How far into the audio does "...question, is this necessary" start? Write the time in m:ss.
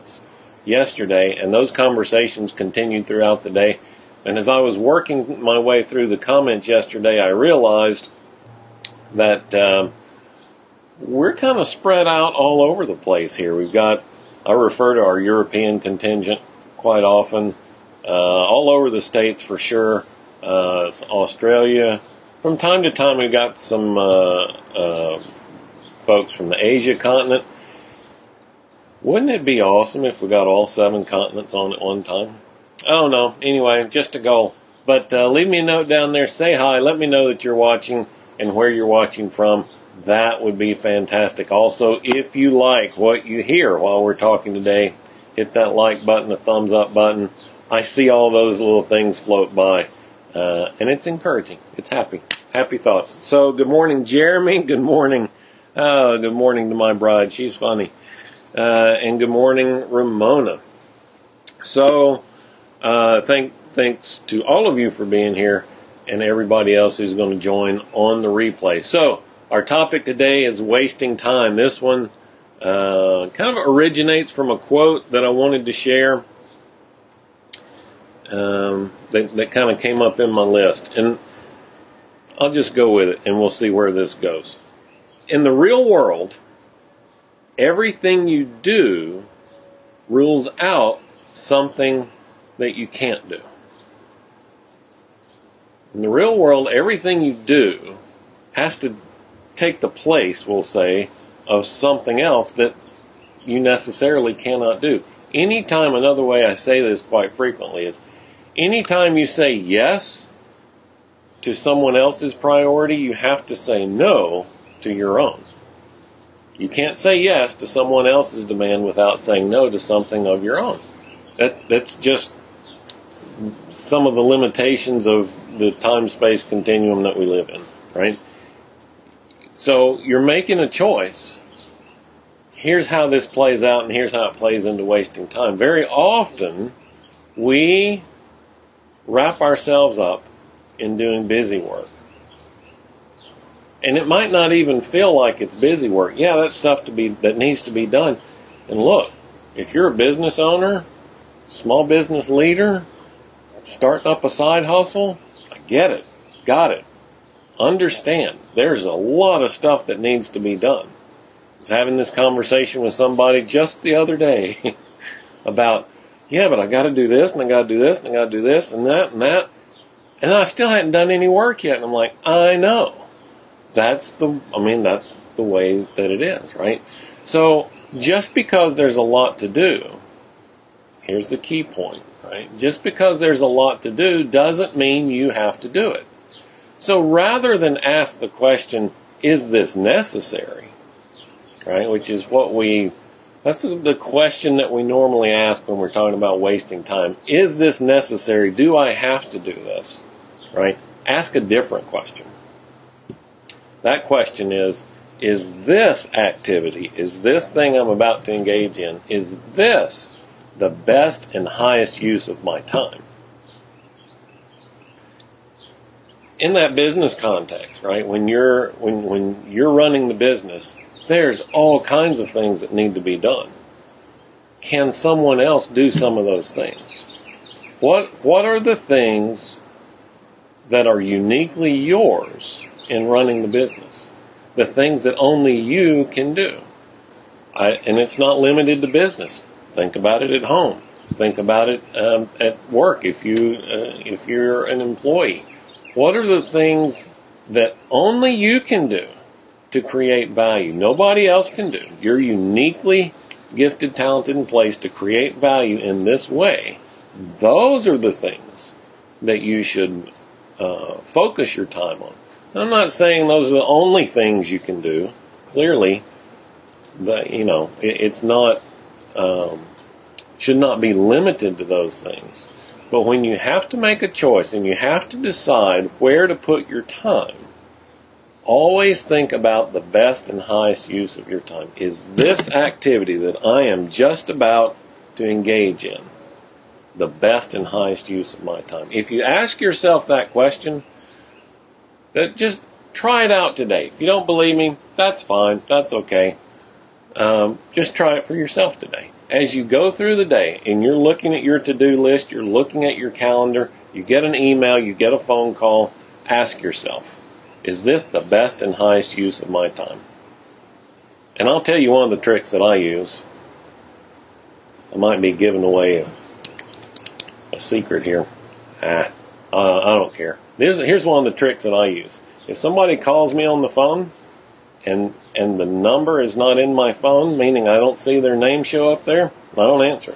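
3:08.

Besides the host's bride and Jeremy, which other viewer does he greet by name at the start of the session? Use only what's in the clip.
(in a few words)
Ramona.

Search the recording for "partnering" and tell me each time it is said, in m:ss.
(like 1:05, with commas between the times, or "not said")
not said.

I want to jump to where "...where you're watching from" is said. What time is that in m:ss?
0:38.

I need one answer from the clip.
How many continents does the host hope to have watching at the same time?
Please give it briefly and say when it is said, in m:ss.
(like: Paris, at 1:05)
7, at 0:30.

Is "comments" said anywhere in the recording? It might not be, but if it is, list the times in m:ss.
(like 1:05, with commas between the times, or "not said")
0:06.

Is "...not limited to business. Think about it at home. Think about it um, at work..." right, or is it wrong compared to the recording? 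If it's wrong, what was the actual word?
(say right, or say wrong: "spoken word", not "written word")
right.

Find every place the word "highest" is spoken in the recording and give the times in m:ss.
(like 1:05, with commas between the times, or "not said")
3:31, 4:40, 4:47, 5:08.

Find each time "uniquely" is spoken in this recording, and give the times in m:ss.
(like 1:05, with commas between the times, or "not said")
3:51, 4:12.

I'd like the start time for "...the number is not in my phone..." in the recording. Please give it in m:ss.
5:25.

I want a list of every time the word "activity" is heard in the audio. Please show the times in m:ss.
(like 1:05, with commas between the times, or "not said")
3:26, 4:42.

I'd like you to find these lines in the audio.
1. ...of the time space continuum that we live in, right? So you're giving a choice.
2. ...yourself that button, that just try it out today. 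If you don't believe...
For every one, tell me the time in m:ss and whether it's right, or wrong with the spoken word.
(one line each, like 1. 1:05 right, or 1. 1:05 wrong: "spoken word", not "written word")
1. 2:05 wrong: "making", not "giving"
2. 4:49 wrong: "question", not "button".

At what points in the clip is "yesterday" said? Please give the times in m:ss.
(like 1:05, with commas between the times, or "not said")
0:00, 0:06.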